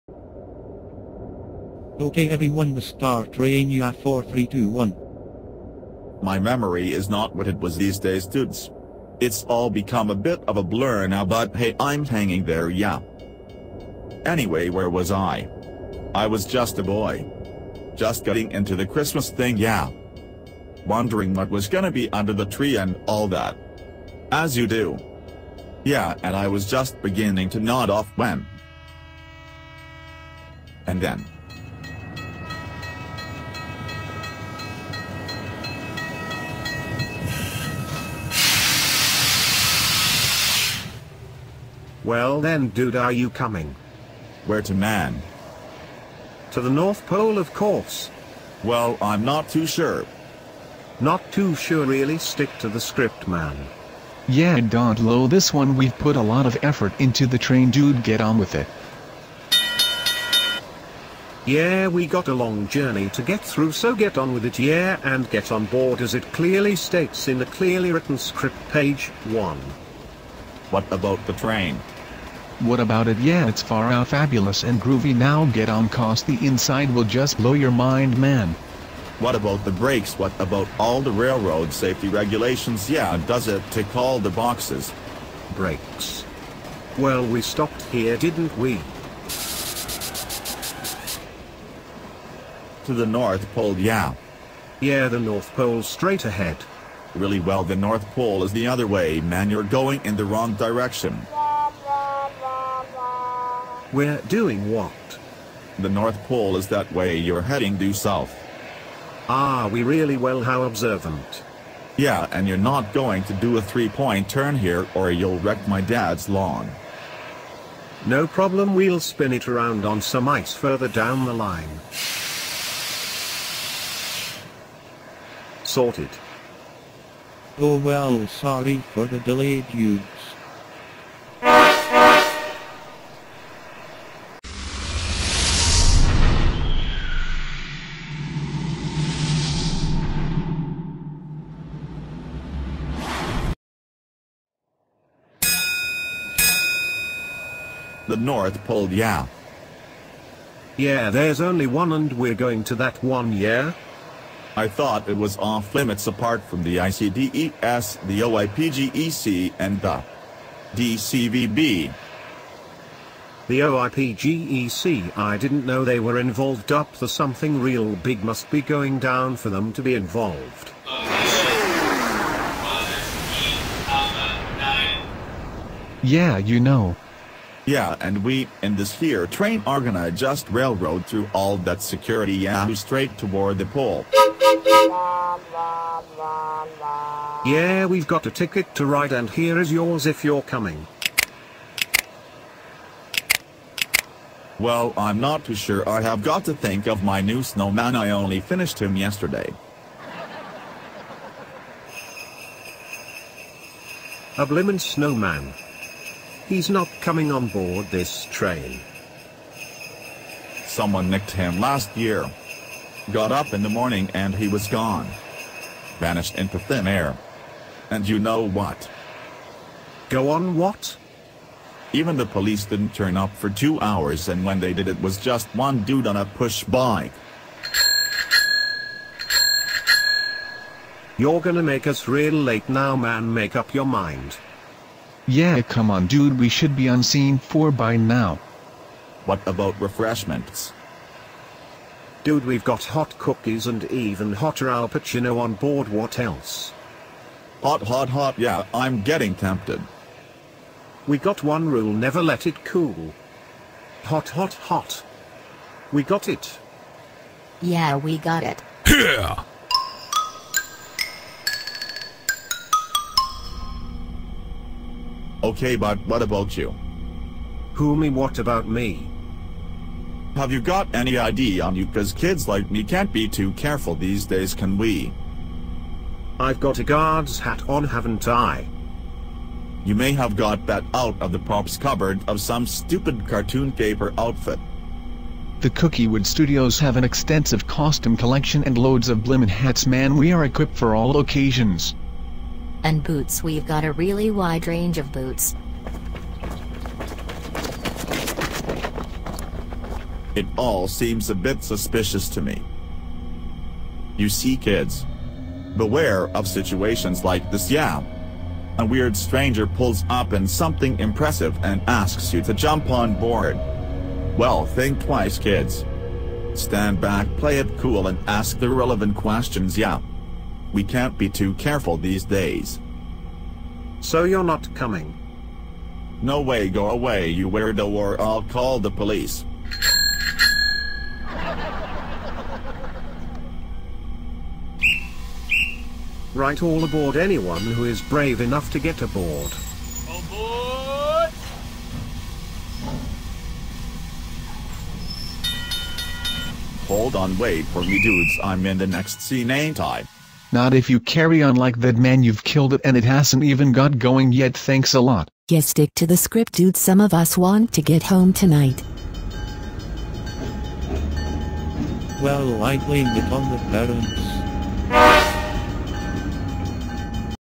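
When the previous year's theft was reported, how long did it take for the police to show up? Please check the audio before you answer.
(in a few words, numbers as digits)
2 hours.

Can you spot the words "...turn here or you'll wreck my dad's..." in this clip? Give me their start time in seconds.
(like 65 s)
114 s.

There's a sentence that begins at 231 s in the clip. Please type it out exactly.
You're gonna make us real late now man make up your mind.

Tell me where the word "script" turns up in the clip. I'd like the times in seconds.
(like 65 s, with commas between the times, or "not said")
52 s, 68 s, 356 s.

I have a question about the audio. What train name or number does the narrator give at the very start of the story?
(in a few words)
Star Train UF4321.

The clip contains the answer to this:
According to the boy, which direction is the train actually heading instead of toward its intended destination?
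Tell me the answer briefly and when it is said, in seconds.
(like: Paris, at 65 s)
Due south, at 107 s.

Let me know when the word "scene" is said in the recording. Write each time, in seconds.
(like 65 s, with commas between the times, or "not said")
237 s, 349 s.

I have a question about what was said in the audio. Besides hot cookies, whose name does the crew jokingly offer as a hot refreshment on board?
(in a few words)
Al Pacino.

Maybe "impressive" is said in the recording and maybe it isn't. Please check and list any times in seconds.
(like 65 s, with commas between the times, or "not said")
310 s.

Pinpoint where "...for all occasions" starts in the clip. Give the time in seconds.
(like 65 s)
290 s.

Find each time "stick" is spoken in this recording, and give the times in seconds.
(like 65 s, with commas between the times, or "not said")
52 s, 355 s.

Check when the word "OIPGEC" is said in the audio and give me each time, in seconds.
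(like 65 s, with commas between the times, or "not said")
158 s, 163 s.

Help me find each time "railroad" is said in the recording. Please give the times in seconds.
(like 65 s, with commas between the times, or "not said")
81 s, 180 s.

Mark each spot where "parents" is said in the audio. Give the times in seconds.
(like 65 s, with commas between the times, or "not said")
364 s.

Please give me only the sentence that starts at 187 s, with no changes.
Yeah, we've got a ticket to ride and here is yours if you're coming.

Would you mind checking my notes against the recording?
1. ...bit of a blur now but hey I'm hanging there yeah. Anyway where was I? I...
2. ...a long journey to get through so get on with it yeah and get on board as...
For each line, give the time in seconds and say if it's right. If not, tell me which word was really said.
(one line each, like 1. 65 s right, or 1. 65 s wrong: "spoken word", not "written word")
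1. 10 s right
2. 62 s right.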